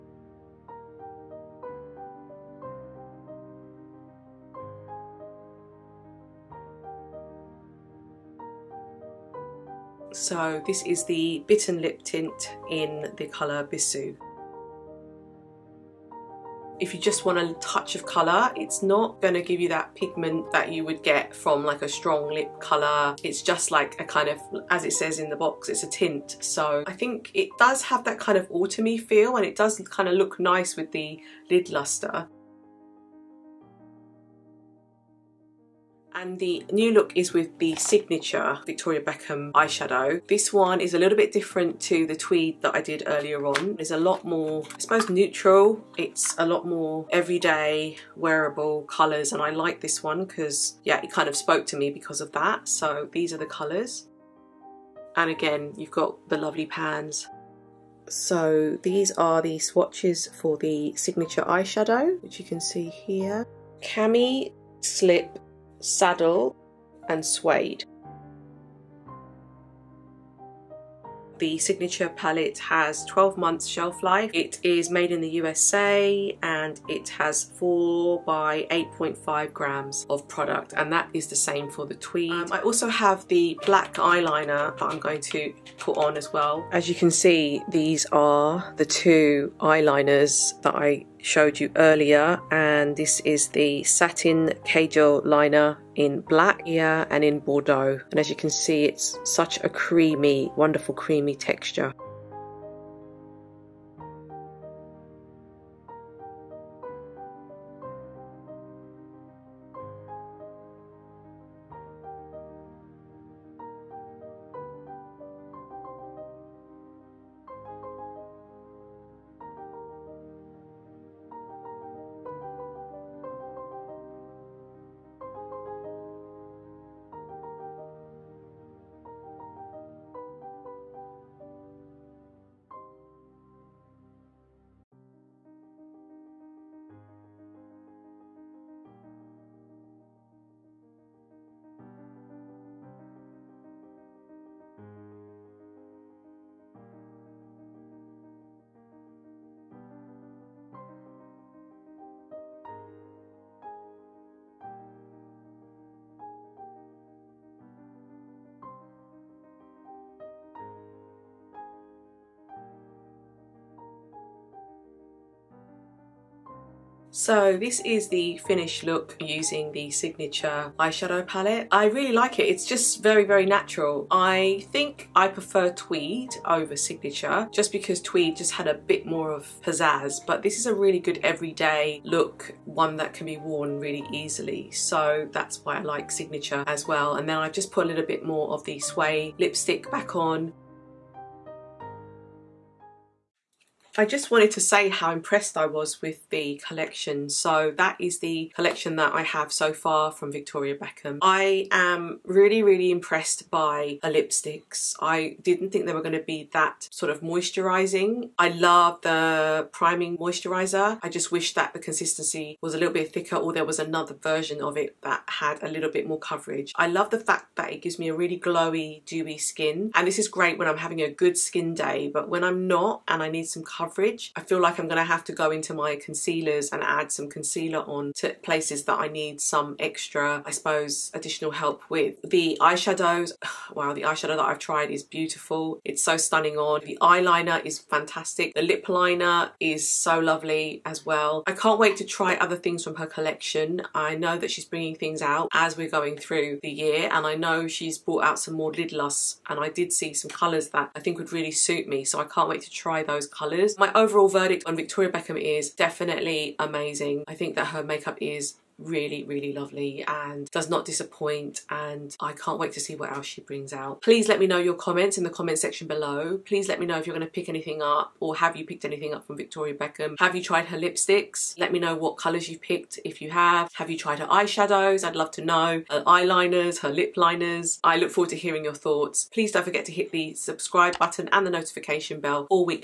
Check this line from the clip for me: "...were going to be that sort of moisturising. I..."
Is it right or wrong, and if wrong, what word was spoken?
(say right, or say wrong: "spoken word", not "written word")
right.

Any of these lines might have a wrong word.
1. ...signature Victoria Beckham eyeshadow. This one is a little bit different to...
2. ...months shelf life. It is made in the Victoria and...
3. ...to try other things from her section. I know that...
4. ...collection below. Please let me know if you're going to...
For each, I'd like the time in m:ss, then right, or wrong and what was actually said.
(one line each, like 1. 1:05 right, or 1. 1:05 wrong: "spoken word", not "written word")
1. 0:37 right
2. 1:13 wrong: "USA", not "Victoria"
3. 4:01 wrong: "collection", not "section"
4. 4:25 wrong: "section", not "collection".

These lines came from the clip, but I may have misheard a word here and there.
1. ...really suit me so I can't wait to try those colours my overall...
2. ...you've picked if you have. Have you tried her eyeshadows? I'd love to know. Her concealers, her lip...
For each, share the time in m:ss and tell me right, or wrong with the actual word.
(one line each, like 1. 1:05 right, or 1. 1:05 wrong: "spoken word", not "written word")
1. 4:11 right
2. 4:32 wrong: "eyeliners", not "concealers".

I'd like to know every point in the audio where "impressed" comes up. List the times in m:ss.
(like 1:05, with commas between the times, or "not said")
3:15, 3:22.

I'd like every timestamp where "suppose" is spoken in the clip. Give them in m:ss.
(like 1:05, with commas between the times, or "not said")
0:44, 3:50.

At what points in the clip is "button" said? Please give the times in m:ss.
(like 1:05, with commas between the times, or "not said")
4:40.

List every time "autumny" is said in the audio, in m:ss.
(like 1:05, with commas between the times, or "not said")
0:28.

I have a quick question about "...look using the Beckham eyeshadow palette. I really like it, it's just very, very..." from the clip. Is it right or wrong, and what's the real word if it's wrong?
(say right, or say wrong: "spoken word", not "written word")
wrong: "Signature", not "Beckham".